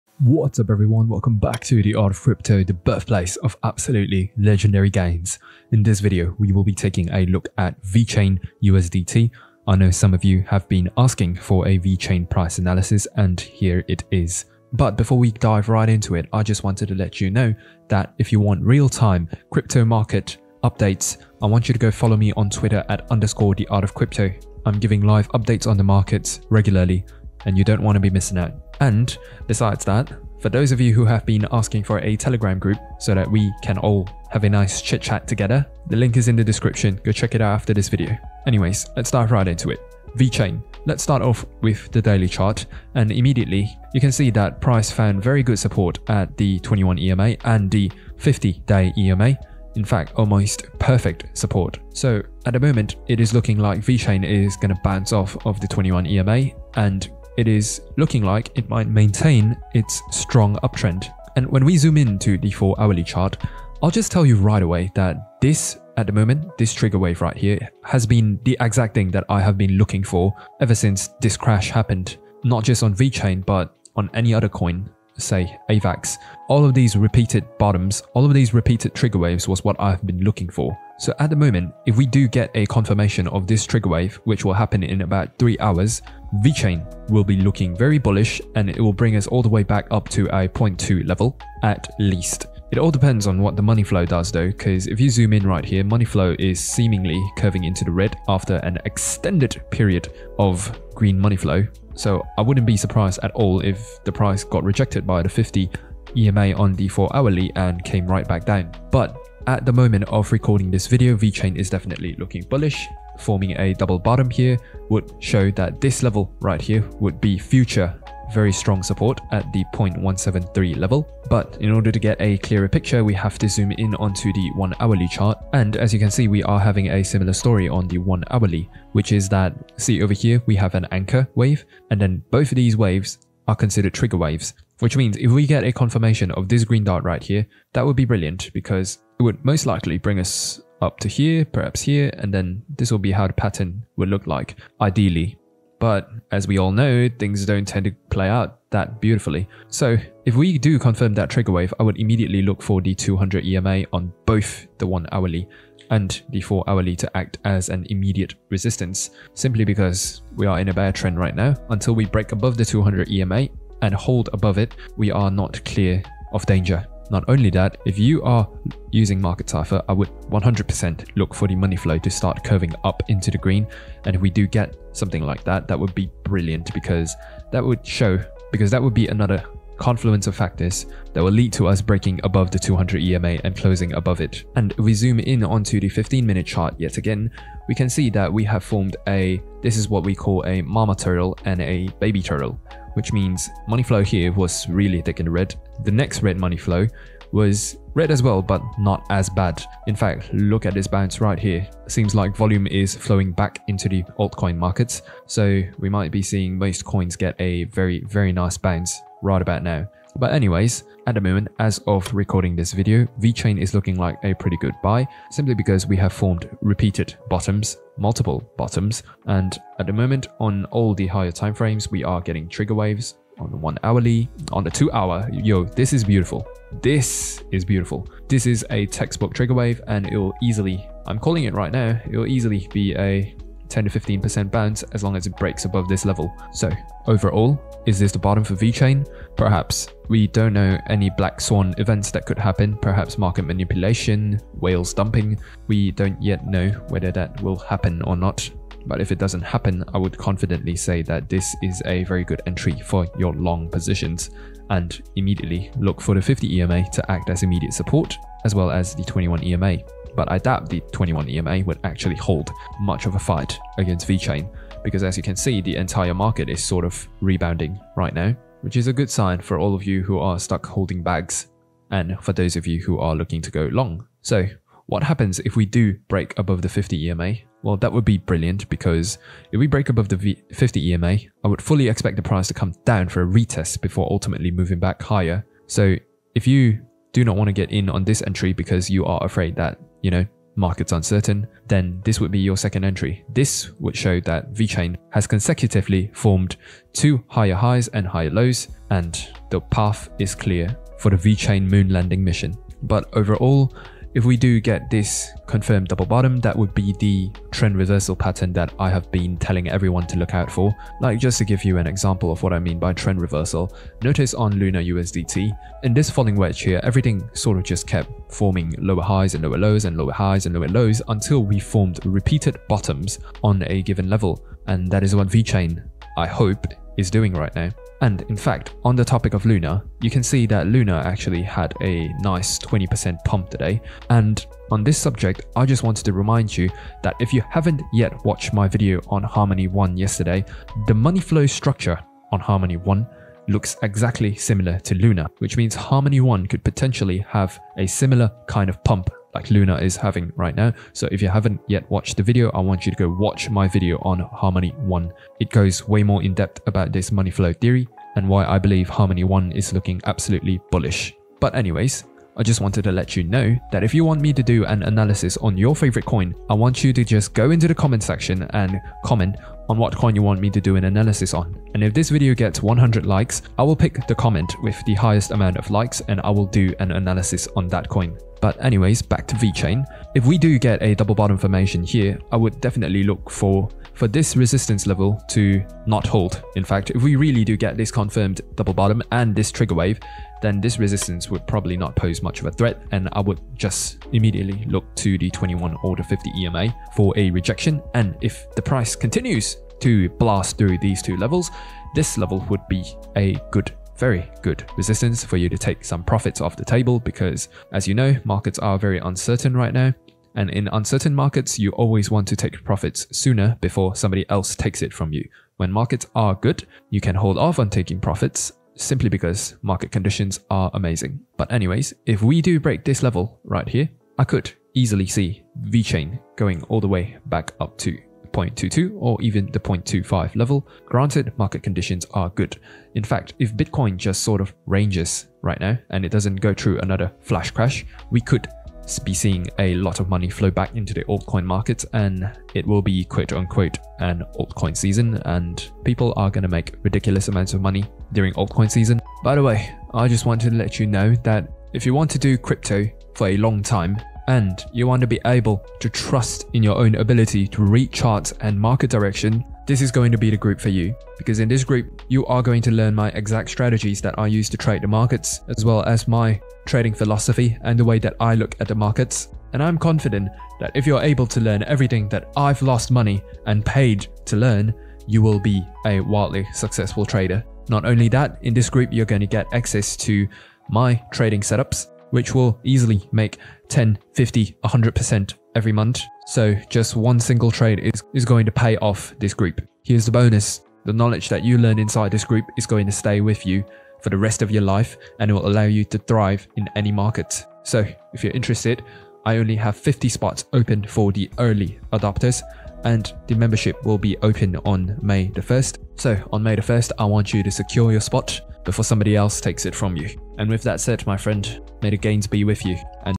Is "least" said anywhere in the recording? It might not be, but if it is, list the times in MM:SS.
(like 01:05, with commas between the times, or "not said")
01:31.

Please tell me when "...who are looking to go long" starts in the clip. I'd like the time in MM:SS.
04:32.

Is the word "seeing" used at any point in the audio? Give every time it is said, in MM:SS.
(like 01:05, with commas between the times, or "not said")
03:26, 07:19.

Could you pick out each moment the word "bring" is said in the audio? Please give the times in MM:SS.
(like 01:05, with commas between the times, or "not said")
01:28, 02:19.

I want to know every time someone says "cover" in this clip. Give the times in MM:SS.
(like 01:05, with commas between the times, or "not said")
not said.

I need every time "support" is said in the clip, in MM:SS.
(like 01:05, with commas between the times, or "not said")
00:45, 00:51, 01:58, 04:17.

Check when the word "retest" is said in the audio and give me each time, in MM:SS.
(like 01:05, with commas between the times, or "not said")
04:43.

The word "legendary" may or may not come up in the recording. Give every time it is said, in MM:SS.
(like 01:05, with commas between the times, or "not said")
00:04.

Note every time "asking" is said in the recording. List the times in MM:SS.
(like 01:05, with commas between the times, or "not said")
00:10, 00:31.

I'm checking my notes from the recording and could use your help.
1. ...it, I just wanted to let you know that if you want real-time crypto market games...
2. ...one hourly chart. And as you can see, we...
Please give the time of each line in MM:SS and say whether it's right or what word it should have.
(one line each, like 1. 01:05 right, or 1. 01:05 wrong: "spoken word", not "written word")
1. 00:16 wrong: "updates", not "games"
2. 02:04 right.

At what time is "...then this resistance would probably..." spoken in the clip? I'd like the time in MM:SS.
06:30.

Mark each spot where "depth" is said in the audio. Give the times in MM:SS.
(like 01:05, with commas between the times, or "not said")
05:56.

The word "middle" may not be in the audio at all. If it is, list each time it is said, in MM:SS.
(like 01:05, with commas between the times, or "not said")
not said.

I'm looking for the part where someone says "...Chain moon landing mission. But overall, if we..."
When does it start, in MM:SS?
05:01.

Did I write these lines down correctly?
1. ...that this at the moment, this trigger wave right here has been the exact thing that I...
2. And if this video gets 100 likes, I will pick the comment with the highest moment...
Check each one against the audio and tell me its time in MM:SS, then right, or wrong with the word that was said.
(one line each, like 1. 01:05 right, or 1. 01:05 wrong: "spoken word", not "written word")
1. 01:04 right
2. 06:11 wrong: "amount", not "moment".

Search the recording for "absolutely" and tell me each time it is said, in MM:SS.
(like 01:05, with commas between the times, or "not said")
00:03, 06:00.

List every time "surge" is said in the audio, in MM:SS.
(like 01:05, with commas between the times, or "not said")
not said.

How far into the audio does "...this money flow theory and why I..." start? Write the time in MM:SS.
05:56.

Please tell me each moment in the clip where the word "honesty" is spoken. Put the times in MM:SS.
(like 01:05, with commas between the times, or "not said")
not said.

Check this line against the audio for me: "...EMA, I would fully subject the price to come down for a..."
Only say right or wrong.
wrong.